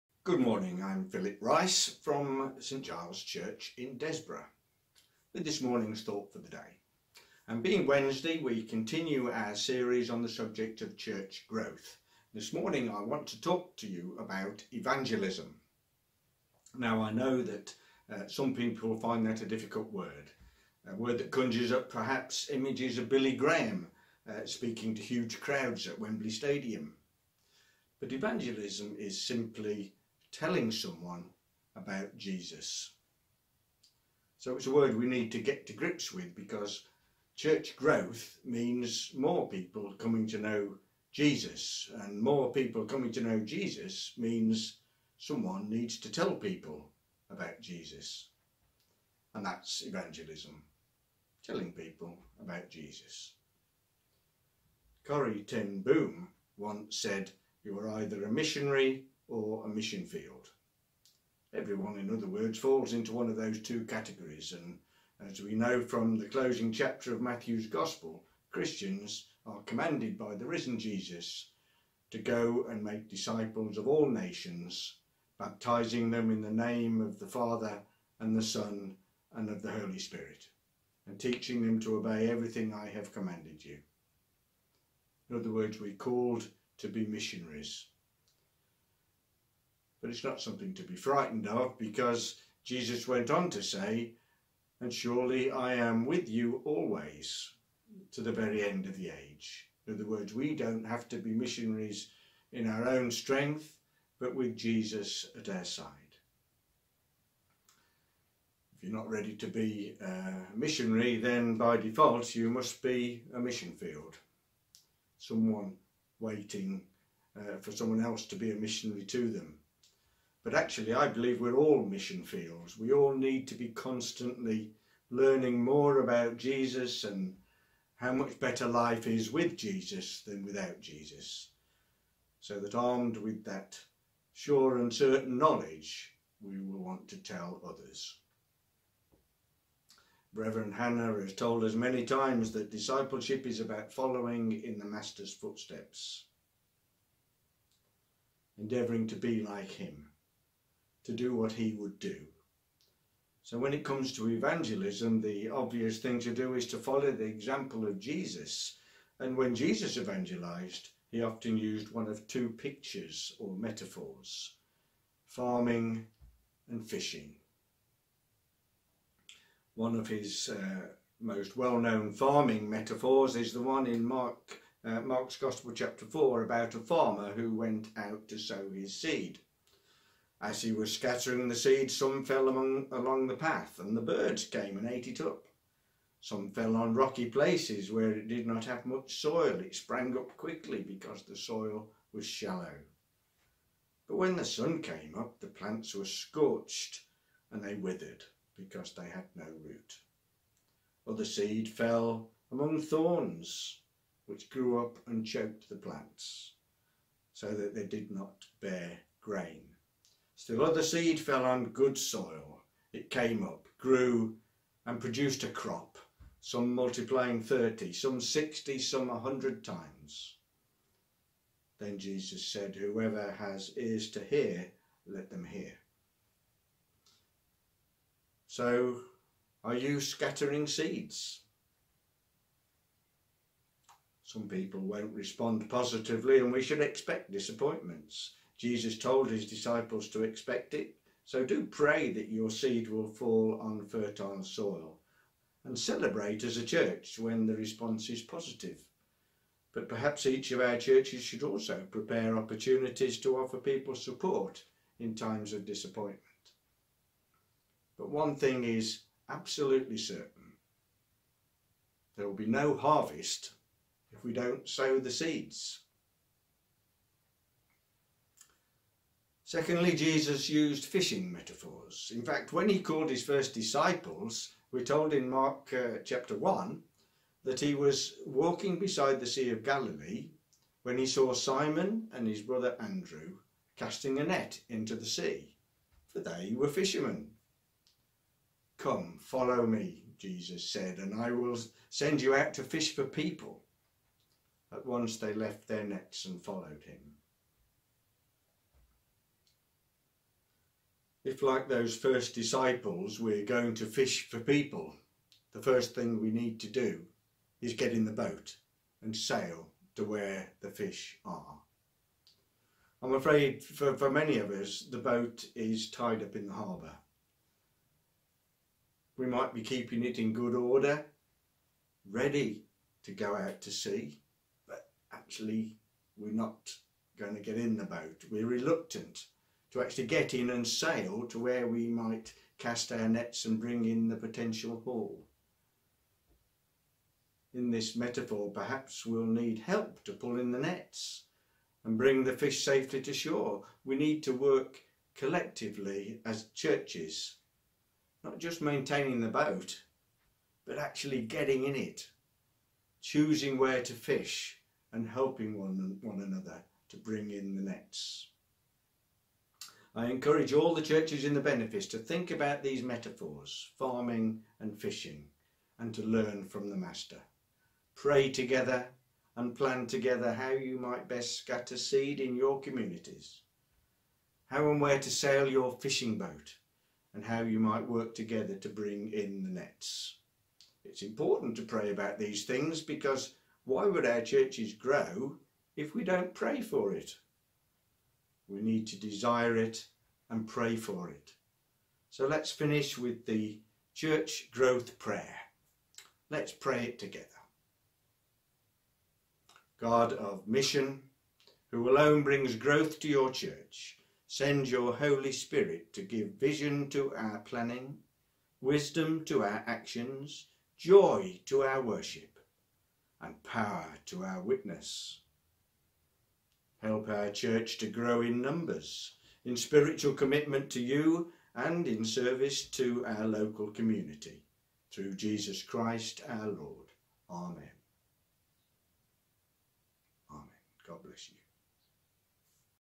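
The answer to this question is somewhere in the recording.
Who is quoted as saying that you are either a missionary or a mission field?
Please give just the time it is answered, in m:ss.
0:55.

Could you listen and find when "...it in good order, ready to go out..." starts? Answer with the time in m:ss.
5:20.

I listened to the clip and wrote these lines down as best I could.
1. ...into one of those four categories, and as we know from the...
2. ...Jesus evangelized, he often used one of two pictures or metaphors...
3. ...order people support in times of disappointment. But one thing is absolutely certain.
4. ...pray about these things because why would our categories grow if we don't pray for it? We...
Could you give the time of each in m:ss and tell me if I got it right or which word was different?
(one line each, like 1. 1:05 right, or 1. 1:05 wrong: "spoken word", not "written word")
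1. 1:02 wrong: "two", not "four"
2. 2:39 right
3. 4:13 wrong: "offer", not "order"
4. 6:21 wrong: "churches", not "categories".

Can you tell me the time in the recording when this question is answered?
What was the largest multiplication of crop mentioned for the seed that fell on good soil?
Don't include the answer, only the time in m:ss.
3:39.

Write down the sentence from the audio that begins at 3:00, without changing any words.
As he was scattering the seeds, some fell among, along the path, and the birds came and ate it up.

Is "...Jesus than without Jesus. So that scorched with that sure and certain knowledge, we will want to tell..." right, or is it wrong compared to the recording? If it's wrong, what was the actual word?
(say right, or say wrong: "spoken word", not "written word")
wrong: "armed", not "scorched".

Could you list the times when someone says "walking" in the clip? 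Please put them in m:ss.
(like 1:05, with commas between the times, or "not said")
4:38.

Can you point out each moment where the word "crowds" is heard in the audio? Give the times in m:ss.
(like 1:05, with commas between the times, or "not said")
0:25.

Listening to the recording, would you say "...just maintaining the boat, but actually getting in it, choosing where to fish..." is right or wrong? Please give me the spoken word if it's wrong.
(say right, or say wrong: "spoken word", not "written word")
right.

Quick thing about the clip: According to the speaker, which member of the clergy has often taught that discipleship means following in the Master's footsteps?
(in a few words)
Reverend Hannah.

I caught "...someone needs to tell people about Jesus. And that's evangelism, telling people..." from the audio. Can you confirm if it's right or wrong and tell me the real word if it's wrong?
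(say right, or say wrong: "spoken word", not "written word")
right.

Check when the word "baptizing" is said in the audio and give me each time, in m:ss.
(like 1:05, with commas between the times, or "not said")
1:15.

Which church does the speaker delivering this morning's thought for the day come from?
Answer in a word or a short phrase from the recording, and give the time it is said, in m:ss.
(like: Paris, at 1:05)
St Giles Church, at 0:02.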